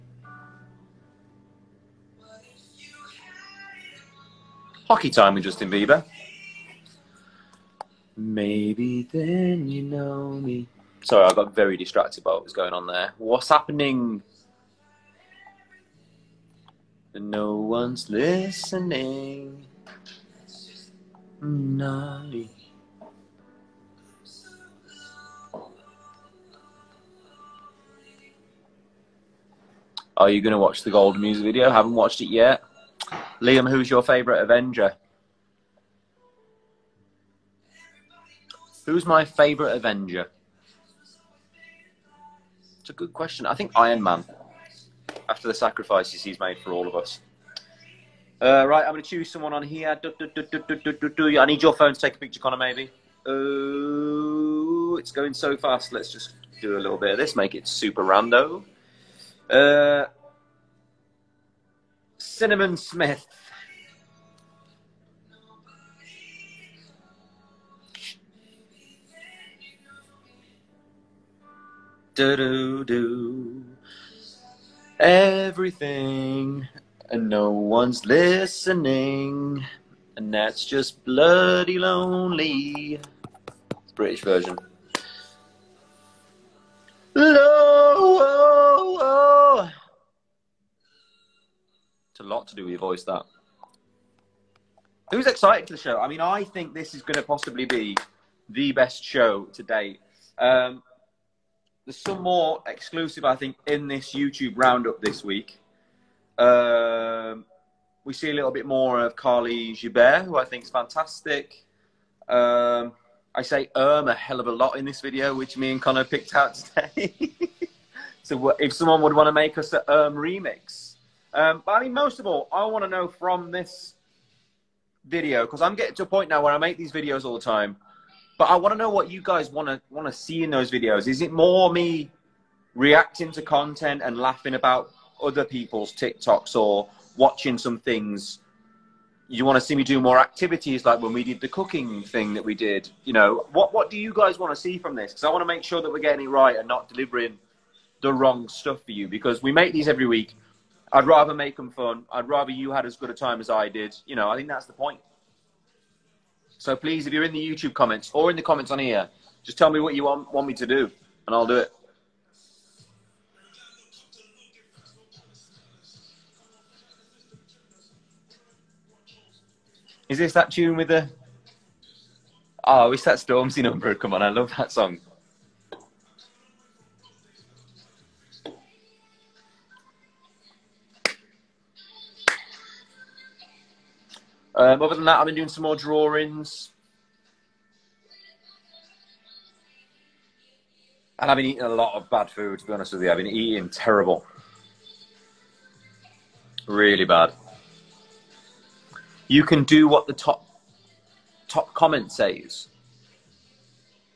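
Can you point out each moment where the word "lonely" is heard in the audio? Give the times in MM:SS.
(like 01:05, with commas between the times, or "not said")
01:21.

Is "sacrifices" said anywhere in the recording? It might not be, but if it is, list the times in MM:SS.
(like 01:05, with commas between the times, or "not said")
00:45.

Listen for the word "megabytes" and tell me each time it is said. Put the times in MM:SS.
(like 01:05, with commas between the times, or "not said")
not said.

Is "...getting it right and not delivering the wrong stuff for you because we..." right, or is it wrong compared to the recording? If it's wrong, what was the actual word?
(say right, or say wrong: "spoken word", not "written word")
right.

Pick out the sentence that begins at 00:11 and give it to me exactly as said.
Sorry, I got very distracted by what was going on there.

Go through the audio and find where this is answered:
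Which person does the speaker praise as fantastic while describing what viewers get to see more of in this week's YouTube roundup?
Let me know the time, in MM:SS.
01:49.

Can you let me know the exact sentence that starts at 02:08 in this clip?
But I want to know what you guys want to want to see in those videos.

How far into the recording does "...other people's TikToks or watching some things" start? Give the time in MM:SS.
02:15.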